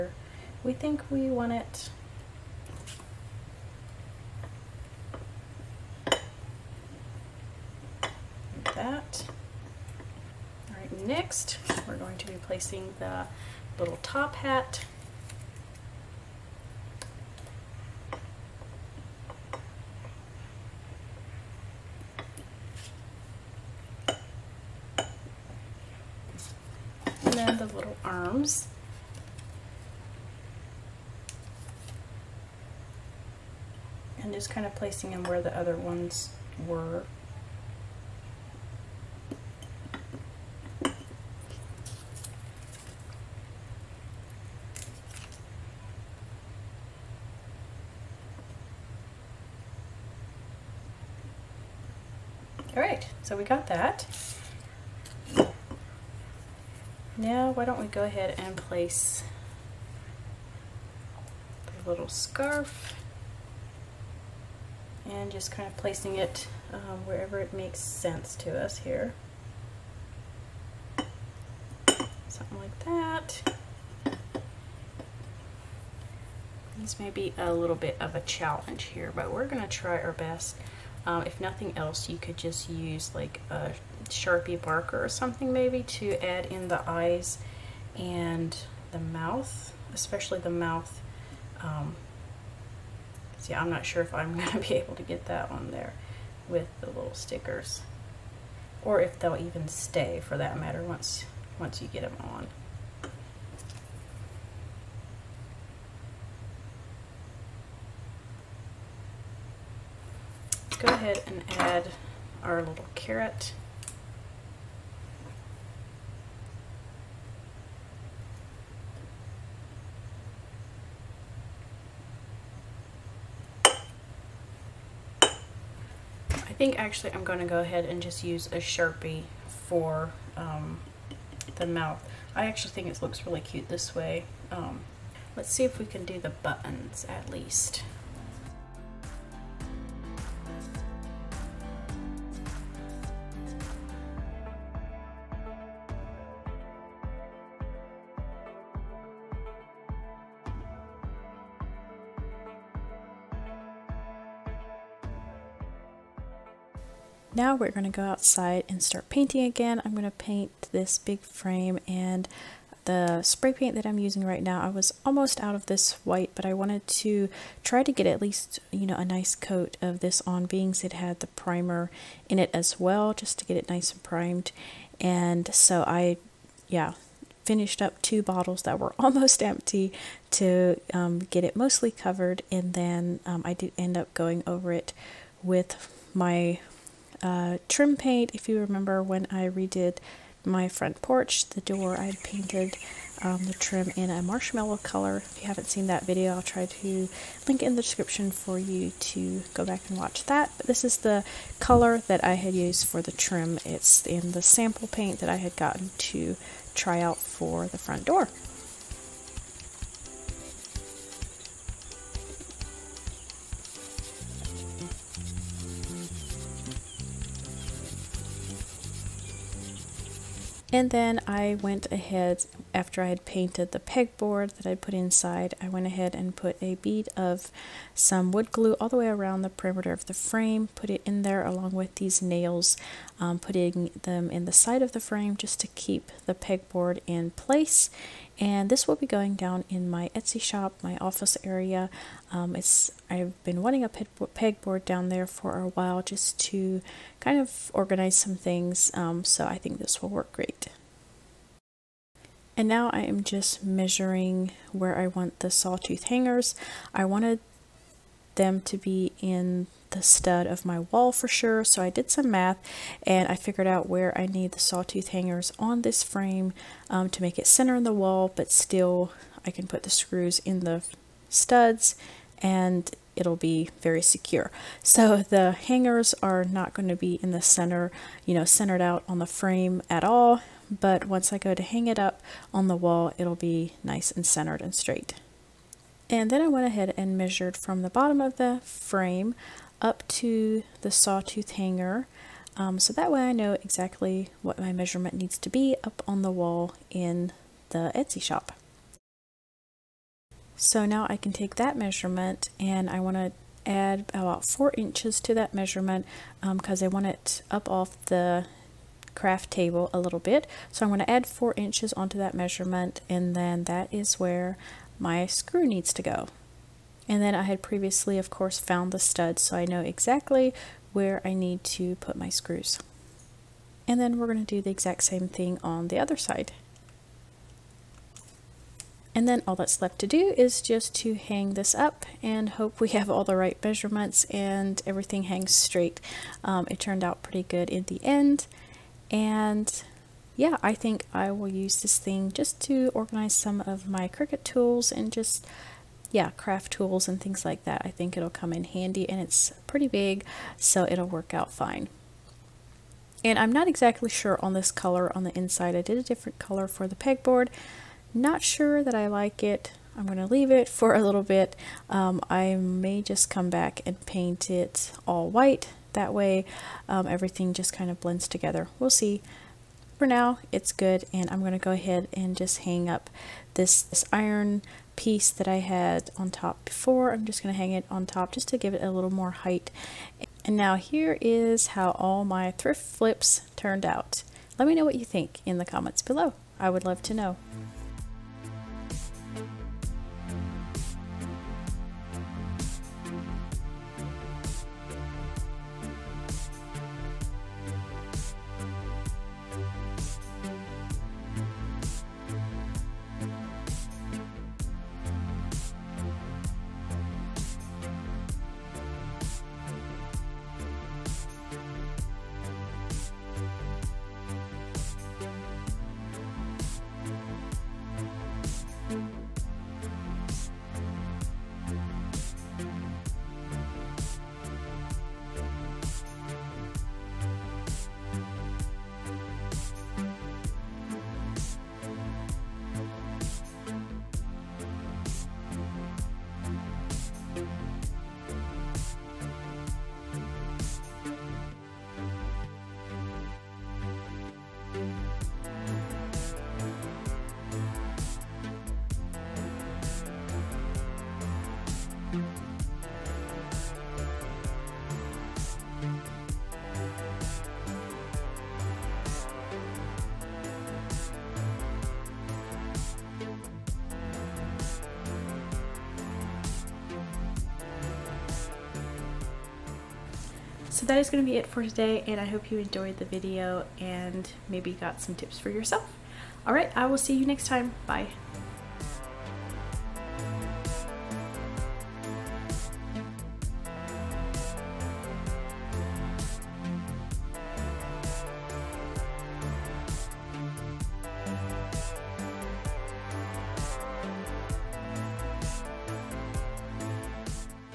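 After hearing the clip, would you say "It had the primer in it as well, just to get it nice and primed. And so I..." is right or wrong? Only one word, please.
right.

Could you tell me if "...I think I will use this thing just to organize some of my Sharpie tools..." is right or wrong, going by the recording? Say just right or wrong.
wrong.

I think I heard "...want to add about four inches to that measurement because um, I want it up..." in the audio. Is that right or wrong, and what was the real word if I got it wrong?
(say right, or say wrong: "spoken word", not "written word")
right.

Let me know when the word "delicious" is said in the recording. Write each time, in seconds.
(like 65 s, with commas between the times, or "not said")
not said.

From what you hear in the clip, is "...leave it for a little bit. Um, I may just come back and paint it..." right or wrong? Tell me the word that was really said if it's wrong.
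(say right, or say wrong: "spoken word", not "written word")
right.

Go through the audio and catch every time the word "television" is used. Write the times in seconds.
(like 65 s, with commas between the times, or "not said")
not said.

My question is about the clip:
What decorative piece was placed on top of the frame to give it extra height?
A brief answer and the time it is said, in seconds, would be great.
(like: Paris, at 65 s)
iron piece, at 374 s.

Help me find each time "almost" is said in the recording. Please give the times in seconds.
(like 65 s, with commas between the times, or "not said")
165 s, 178 s.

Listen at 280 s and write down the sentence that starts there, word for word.
But once I go to hang it up on the wall, it'll be nice and centered and straight.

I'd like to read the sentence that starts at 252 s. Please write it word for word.
And now I am just measuring where I want the sawtooth hangers.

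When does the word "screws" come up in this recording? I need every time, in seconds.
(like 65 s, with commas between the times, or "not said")
269 s, 315 s, 322 s.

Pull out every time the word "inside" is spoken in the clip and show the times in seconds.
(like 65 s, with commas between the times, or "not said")
224 s, 355 s.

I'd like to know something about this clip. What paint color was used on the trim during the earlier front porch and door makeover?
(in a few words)
marshmallow.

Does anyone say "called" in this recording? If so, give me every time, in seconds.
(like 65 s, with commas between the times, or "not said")
not said.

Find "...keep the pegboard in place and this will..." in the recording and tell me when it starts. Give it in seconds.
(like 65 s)
235 s.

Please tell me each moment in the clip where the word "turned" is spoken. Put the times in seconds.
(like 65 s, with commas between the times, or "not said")
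336 s, 383 s.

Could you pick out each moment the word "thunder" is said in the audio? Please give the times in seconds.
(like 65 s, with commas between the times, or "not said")
not said.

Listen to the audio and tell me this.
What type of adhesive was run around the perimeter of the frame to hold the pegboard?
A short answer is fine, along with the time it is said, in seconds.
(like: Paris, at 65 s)
wood glue, at 228 s.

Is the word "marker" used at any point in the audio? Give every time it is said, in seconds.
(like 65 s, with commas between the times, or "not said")
84 s.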